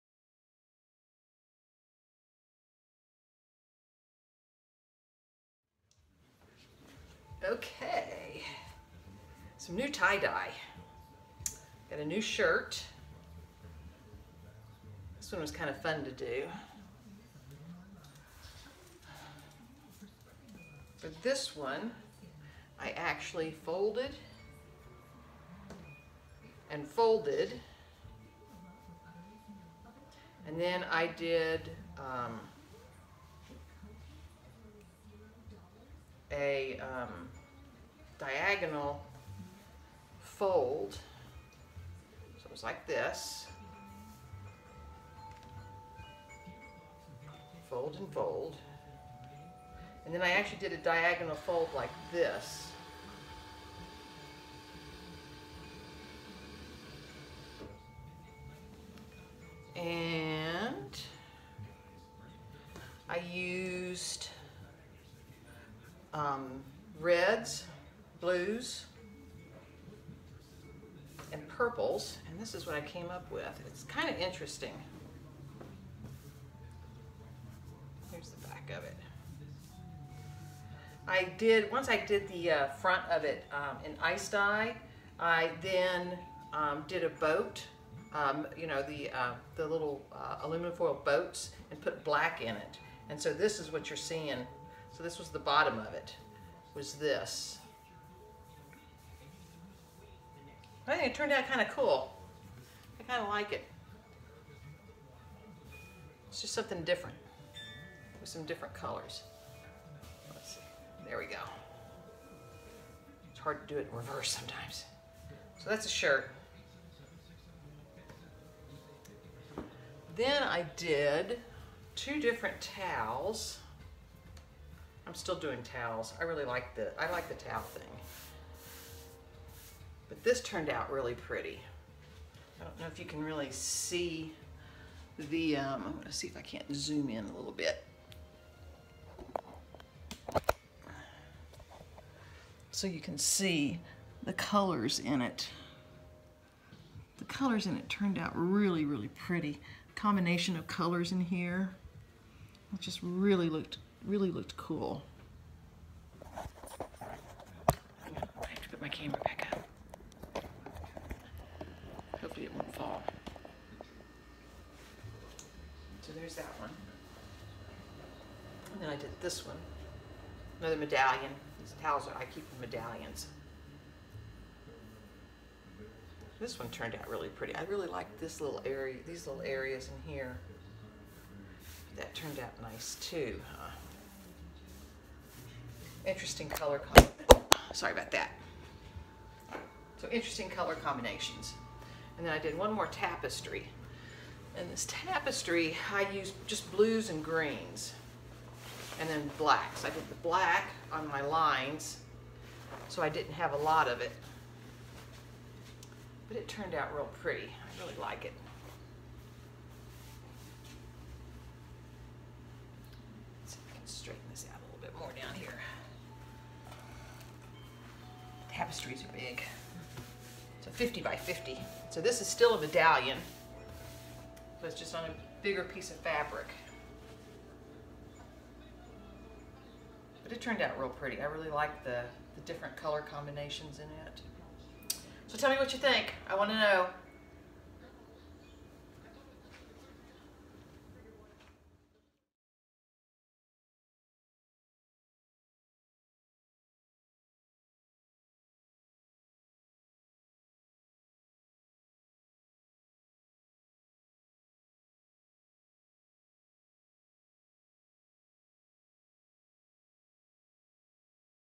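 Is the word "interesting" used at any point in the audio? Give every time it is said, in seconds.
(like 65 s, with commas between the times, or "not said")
74 s, 186 s, 190 s.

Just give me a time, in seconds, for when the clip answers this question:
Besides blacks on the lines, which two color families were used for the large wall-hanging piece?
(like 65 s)
196 s.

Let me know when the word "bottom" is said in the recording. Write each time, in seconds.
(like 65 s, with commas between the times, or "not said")
95 s.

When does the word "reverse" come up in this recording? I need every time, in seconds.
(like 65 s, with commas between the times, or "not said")
113 s.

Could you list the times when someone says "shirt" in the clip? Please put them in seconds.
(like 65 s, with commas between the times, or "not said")
12 s, 115 s.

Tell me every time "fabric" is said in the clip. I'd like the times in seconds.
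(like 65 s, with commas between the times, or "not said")
225 s.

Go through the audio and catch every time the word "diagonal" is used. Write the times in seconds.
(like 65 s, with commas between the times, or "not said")
38 s, 50 s.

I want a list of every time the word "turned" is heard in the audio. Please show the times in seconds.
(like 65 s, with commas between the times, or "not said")
101 s, 130 s, 147 s, 176 s, 182 s, 206 s, 230 s.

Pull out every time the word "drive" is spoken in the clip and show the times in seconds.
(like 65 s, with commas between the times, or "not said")
not said.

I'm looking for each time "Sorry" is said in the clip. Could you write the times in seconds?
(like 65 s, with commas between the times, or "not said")
187 s.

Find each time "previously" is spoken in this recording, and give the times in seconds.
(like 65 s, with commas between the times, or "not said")
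not said.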